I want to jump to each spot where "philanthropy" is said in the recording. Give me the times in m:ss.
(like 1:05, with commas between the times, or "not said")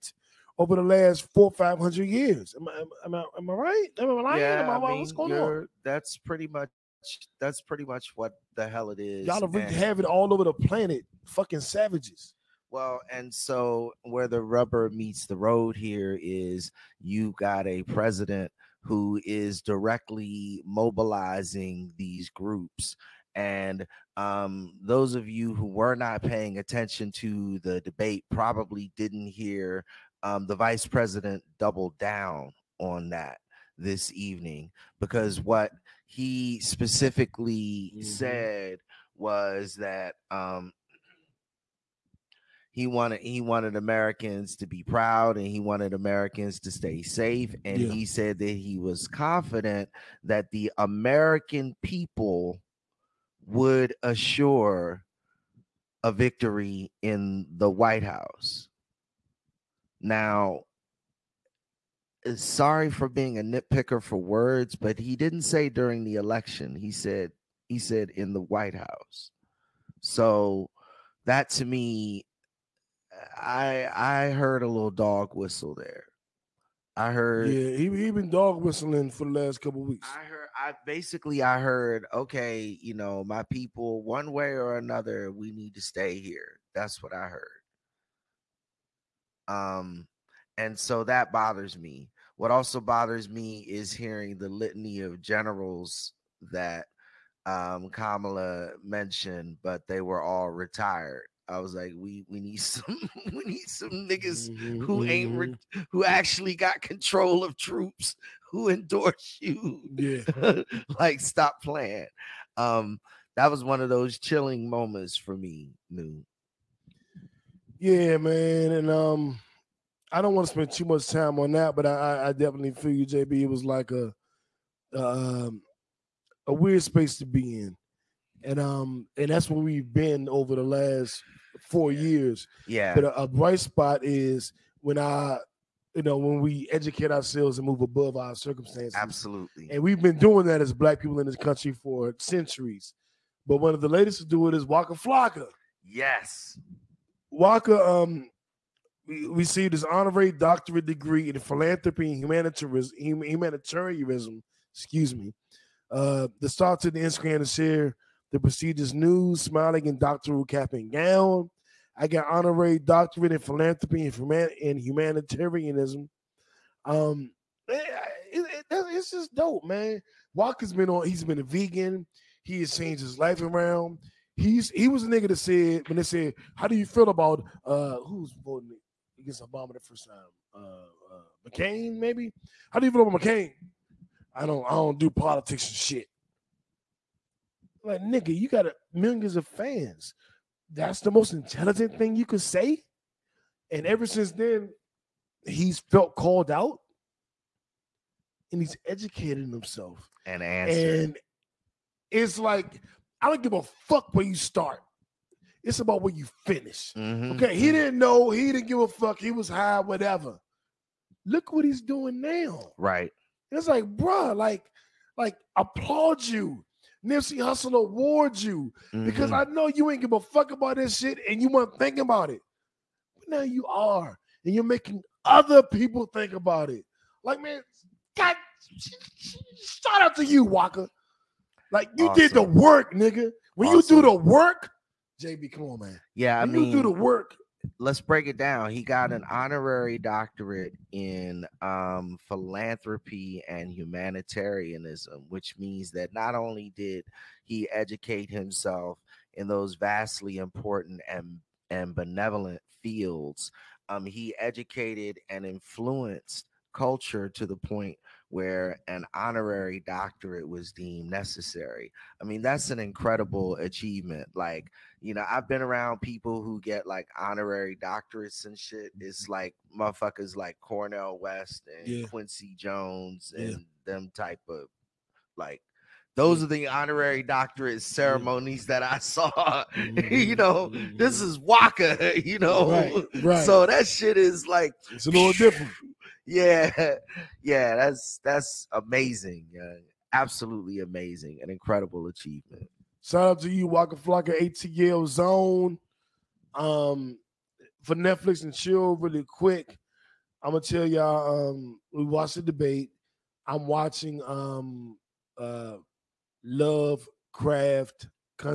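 2:31, 2:43, 4:02.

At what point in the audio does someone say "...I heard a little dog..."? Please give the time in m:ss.
1:14.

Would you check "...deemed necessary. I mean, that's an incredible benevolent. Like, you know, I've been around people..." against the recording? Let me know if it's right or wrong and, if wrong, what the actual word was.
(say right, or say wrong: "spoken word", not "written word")
wrong: "achievement", not "benevolent".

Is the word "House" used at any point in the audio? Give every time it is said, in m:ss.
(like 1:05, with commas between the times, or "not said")
0:58, 1:08.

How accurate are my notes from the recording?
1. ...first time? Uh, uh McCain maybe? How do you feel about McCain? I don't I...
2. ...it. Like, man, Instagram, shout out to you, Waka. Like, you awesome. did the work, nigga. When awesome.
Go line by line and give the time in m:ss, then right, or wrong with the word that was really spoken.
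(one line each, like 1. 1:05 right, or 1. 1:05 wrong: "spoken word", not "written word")
1. 2:59 right
2. 3:46 wrong: "God", not "Instagram".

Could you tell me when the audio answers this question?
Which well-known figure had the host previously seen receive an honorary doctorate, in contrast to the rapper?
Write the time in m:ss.
4:30.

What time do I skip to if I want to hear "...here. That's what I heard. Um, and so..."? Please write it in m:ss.
1:26.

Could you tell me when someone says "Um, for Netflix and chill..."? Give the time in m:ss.
4:56.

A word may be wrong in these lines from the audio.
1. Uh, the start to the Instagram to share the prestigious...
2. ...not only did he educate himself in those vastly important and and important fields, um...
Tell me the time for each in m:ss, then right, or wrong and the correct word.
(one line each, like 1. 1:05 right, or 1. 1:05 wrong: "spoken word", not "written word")
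1. 2:35 right
2. 4:06 wrong: "benevolent", not "important".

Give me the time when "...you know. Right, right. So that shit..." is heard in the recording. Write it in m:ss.
4:42.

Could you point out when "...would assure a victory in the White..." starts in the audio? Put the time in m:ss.
0:53.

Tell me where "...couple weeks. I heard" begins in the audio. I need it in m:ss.
1:19.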